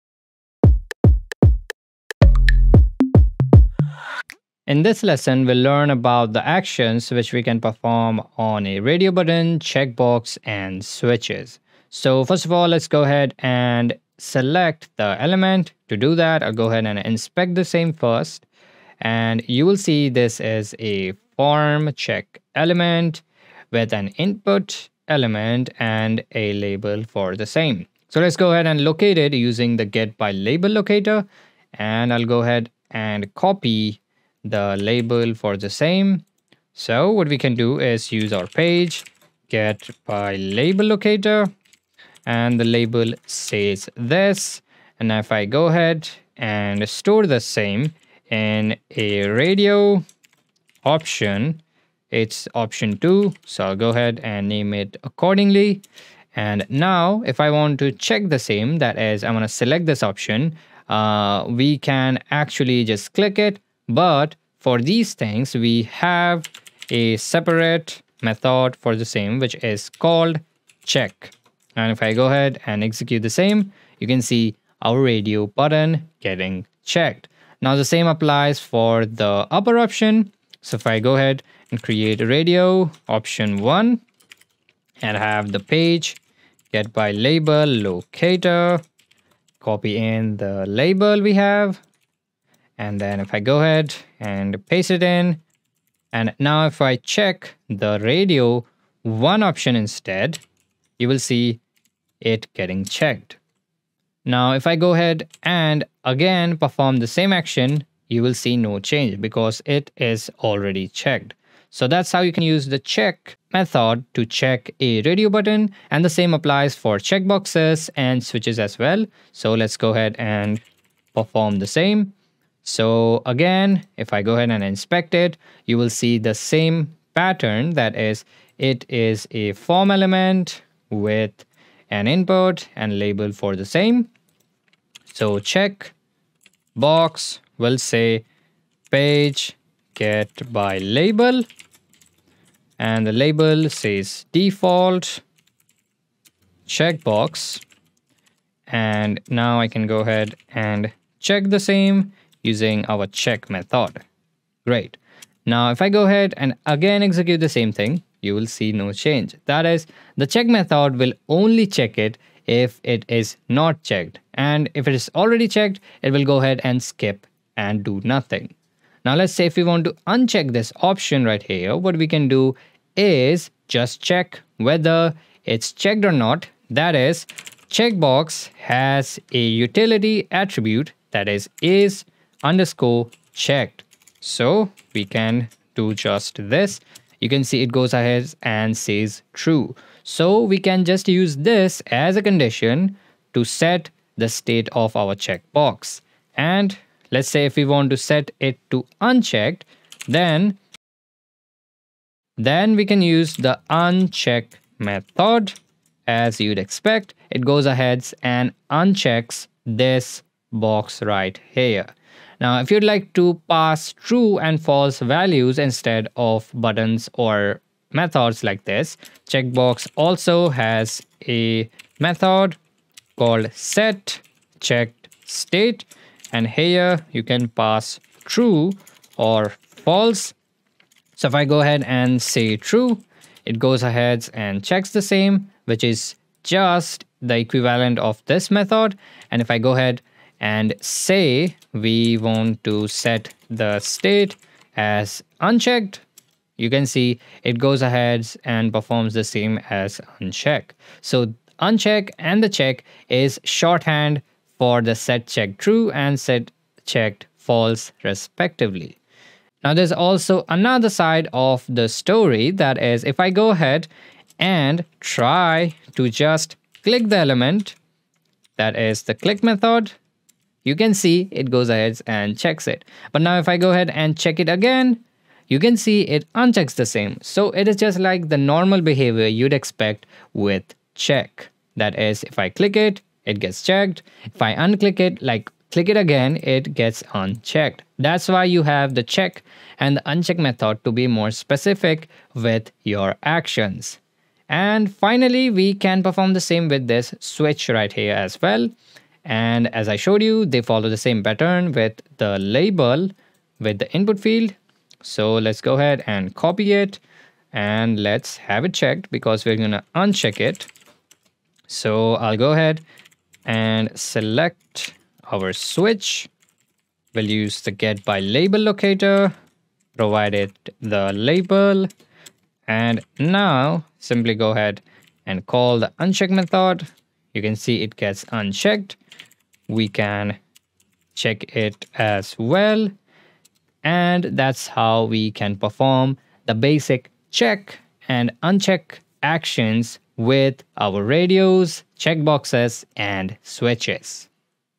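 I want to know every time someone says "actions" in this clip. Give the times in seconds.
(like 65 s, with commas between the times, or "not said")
6 s, 107 s, 293 s, 339 s.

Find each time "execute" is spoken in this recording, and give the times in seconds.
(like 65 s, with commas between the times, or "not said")
72 s, 157 s.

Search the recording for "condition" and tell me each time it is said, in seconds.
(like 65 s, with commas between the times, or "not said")
192 s.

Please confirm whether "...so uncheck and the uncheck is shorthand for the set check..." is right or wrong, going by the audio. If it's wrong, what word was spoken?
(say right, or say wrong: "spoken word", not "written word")
wrong: "check", not "uncheck".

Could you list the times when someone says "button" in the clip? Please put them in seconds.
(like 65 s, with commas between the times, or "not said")
9 s, 75 s, 115 s, 216 s.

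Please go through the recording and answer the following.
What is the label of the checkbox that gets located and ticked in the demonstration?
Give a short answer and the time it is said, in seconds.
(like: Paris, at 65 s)
default checkbox, at 144 s.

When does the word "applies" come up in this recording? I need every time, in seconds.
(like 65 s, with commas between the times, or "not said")
78 s, 116 s.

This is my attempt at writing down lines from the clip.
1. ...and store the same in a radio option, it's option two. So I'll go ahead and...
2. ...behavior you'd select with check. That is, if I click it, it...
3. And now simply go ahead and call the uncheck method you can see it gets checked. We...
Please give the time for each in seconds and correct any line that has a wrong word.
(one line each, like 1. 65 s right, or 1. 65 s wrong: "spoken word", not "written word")
1. 46 s right
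2. 278 s wrong: "expect", not "select"
3. 322 s wrong: "unchecked", not "checked".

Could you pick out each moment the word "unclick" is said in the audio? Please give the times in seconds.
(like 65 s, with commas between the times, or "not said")
284 s.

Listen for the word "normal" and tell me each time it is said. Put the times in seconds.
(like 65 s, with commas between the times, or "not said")
278 s.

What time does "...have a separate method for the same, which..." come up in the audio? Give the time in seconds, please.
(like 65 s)
65 s.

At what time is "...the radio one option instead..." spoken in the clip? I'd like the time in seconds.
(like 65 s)
97 s.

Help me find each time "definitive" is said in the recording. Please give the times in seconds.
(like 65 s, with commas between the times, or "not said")
not said.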